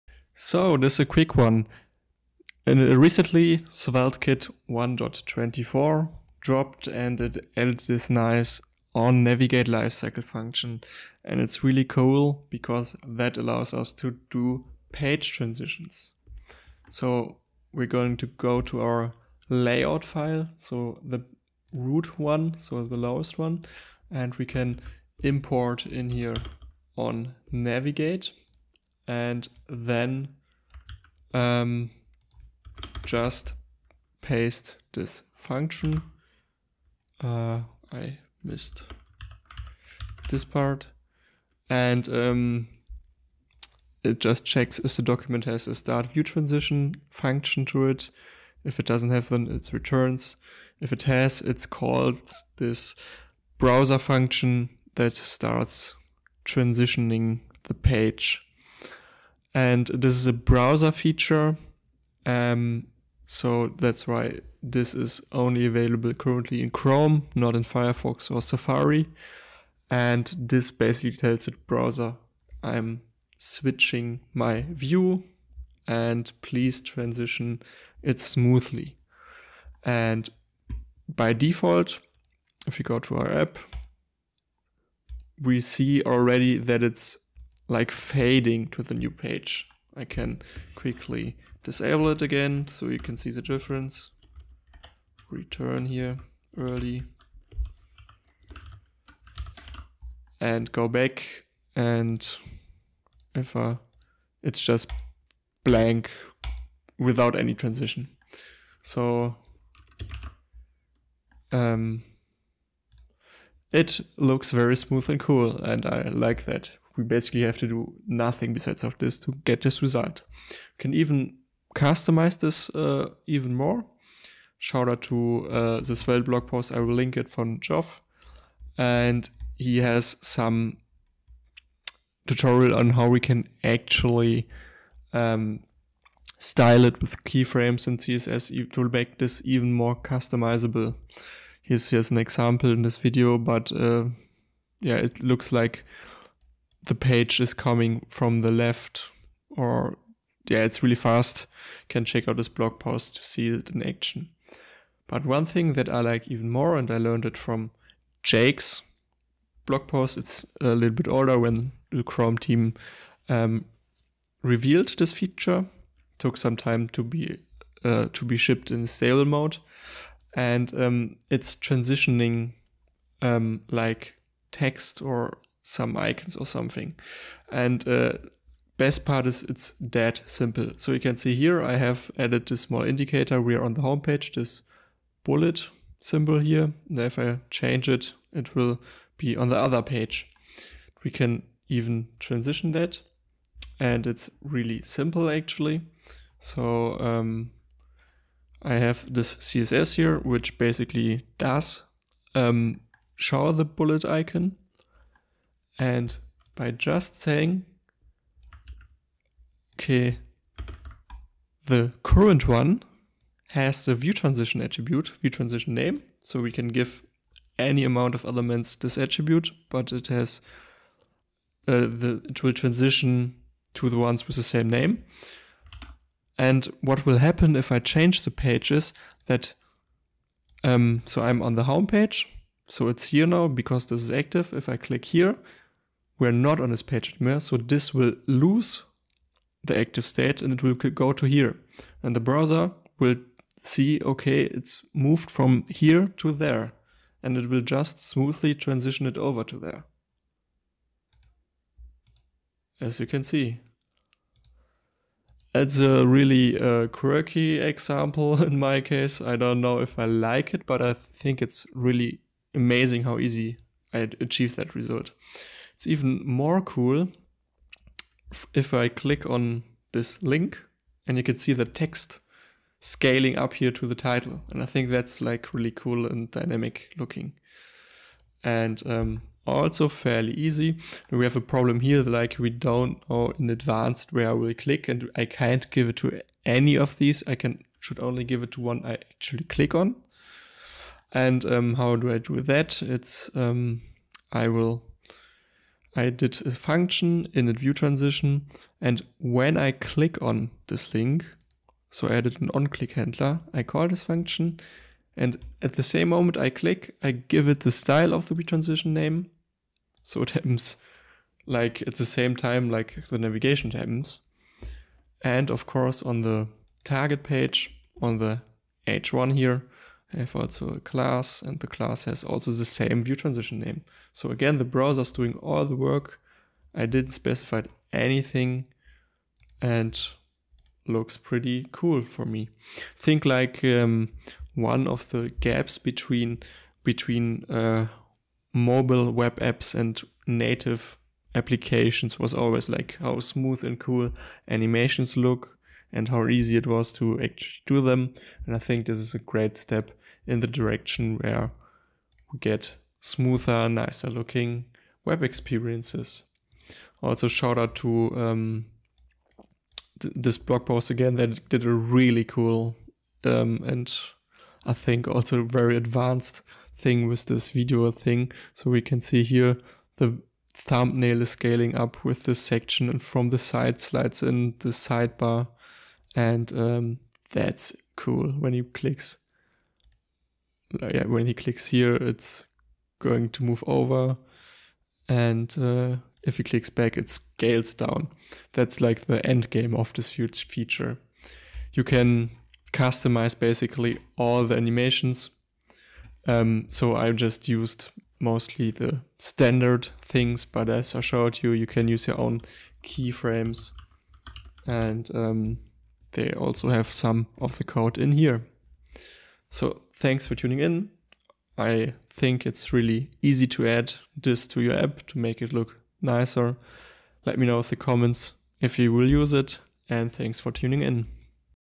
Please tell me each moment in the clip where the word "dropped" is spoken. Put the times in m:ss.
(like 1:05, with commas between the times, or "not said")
0:06.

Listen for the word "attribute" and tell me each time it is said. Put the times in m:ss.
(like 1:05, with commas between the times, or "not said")
3:34, 3:38.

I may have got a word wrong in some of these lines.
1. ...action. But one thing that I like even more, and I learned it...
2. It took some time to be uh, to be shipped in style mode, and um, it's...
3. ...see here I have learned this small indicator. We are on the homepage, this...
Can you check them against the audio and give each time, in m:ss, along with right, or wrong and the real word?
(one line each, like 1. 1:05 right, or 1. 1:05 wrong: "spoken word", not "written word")
1. 2:33 right
2. 2:45 wrong: "stable", not "style"
3. 3:01 wrong: "added", not "learned".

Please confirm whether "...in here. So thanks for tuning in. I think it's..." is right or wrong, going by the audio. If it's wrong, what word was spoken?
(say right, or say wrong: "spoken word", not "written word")
right.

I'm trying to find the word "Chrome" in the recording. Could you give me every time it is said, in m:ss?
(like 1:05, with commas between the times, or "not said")
1:06, 2:42.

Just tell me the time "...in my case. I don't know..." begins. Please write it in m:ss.
4:18.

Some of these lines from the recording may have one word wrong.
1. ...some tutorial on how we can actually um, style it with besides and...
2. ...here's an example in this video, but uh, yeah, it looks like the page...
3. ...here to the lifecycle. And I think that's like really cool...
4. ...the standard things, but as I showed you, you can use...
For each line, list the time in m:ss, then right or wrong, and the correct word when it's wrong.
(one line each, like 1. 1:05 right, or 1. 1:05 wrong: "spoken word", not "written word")
1. 2:10 wrong: "keyframes", not "besides"
2. 2:21 right
3. 4:33 wrong: "title", not "lifecycle"
4. 6:38 right.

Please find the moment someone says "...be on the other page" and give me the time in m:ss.
3:09.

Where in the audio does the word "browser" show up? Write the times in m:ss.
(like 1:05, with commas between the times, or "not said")
0:53, 1:00, 1:11, 4:02, 5:24.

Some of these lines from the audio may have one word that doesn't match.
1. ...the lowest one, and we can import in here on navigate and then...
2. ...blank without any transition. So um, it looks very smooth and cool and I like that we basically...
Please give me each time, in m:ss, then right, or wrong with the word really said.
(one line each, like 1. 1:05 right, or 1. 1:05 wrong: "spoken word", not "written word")
1. 0:22 right
2. 1:45 right.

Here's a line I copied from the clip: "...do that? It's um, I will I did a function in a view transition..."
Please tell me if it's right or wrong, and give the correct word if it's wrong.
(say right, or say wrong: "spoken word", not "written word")
right.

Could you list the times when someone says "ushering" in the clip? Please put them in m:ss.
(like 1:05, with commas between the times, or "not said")
not said.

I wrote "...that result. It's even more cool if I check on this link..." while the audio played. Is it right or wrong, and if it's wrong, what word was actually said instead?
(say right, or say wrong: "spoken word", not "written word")
wrong: "click", not "check".